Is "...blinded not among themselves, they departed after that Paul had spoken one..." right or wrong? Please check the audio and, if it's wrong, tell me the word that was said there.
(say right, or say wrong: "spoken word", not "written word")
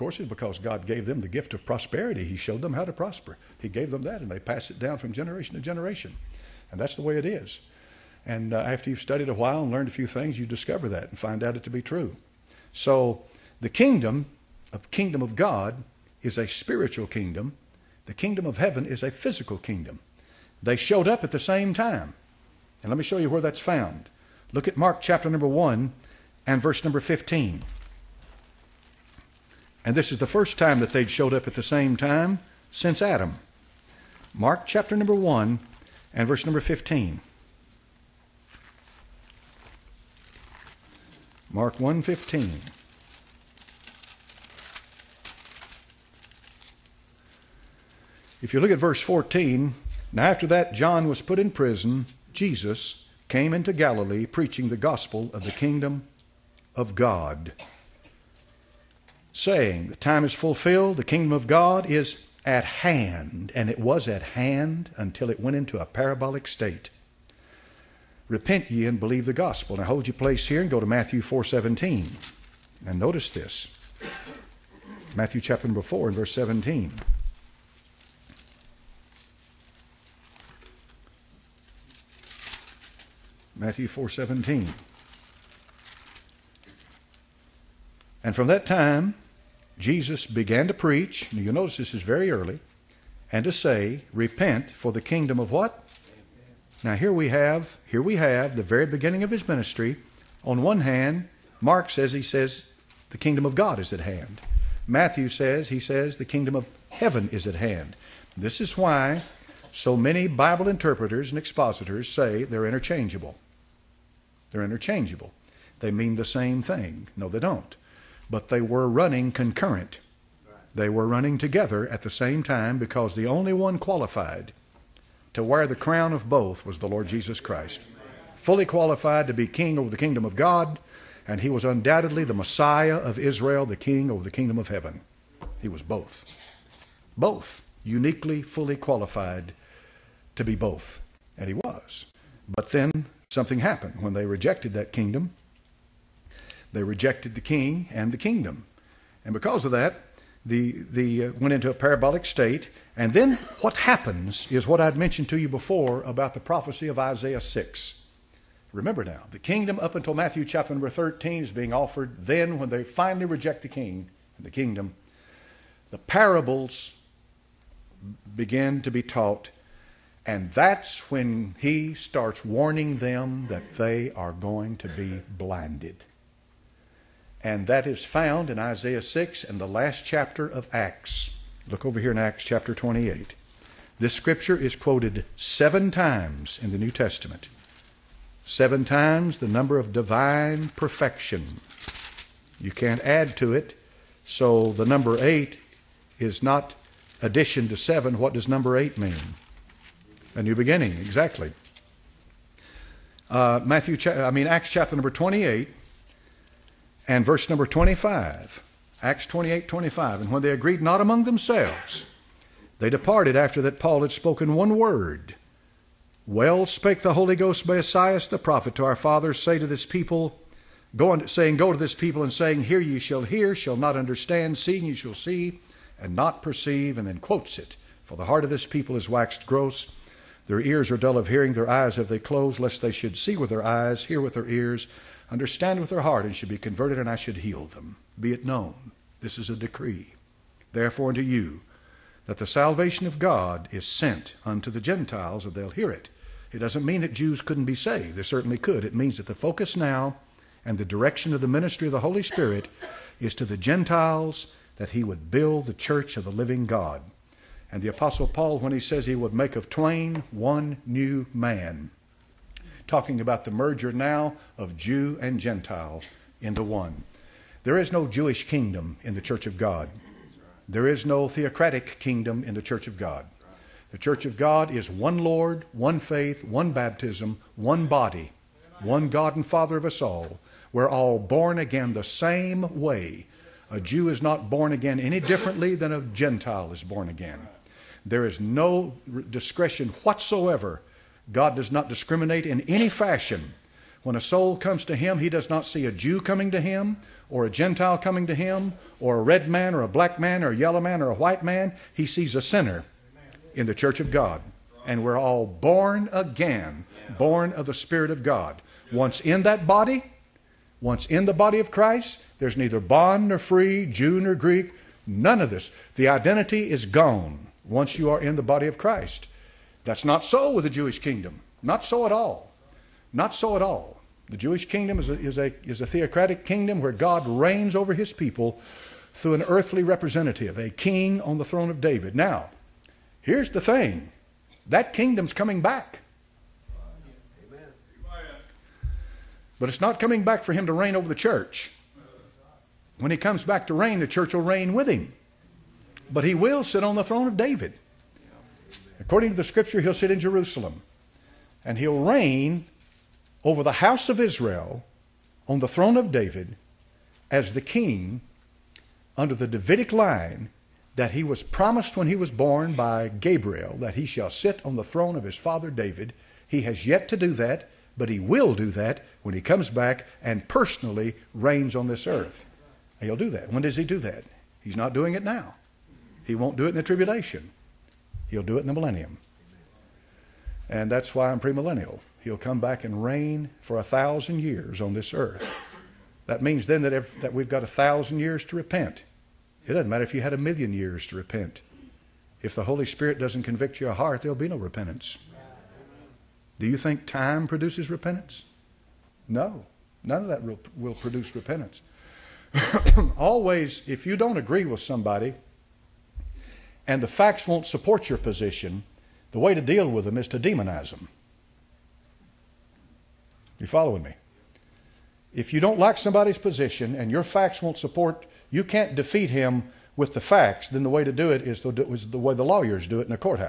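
wrong: "agreed", not "blinded".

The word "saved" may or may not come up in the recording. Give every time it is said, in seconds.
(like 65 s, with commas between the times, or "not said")
247 s.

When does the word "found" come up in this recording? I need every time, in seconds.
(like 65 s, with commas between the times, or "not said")
23 s, 178 s.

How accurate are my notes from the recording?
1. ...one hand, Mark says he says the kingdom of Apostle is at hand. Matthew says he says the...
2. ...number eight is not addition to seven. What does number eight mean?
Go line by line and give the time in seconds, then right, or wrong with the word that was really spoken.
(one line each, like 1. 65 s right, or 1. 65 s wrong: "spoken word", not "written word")
1. 100 s wrong: "God", not "Apostle"
2. 194 s right.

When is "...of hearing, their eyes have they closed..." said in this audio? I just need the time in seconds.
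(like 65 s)
231 s.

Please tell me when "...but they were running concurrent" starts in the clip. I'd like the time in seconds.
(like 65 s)
118 s.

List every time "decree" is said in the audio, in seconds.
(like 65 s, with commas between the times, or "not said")
239 s.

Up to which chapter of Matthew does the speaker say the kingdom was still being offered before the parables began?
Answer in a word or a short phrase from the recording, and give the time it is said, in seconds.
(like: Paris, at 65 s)
Chapter 13, at 160 s.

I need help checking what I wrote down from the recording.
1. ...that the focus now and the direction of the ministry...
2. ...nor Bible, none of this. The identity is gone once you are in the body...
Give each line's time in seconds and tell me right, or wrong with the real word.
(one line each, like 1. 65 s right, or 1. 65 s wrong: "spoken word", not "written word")
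1. 249 s right
2. 314 s wrong: "Greek", not "Bible".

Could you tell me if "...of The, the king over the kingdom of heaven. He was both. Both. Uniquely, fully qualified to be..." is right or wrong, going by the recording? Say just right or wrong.
wrong.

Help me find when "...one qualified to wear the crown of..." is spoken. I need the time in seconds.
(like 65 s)
123 s.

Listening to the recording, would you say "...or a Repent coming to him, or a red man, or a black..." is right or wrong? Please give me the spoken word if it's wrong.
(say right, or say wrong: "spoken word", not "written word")
wrong: "Gentile", not "Repent".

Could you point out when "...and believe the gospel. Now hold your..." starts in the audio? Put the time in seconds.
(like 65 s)
68 s.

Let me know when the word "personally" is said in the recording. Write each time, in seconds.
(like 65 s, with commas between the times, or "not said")
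370 s.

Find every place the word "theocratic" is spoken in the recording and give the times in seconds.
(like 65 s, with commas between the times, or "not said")
271 s, 325 s.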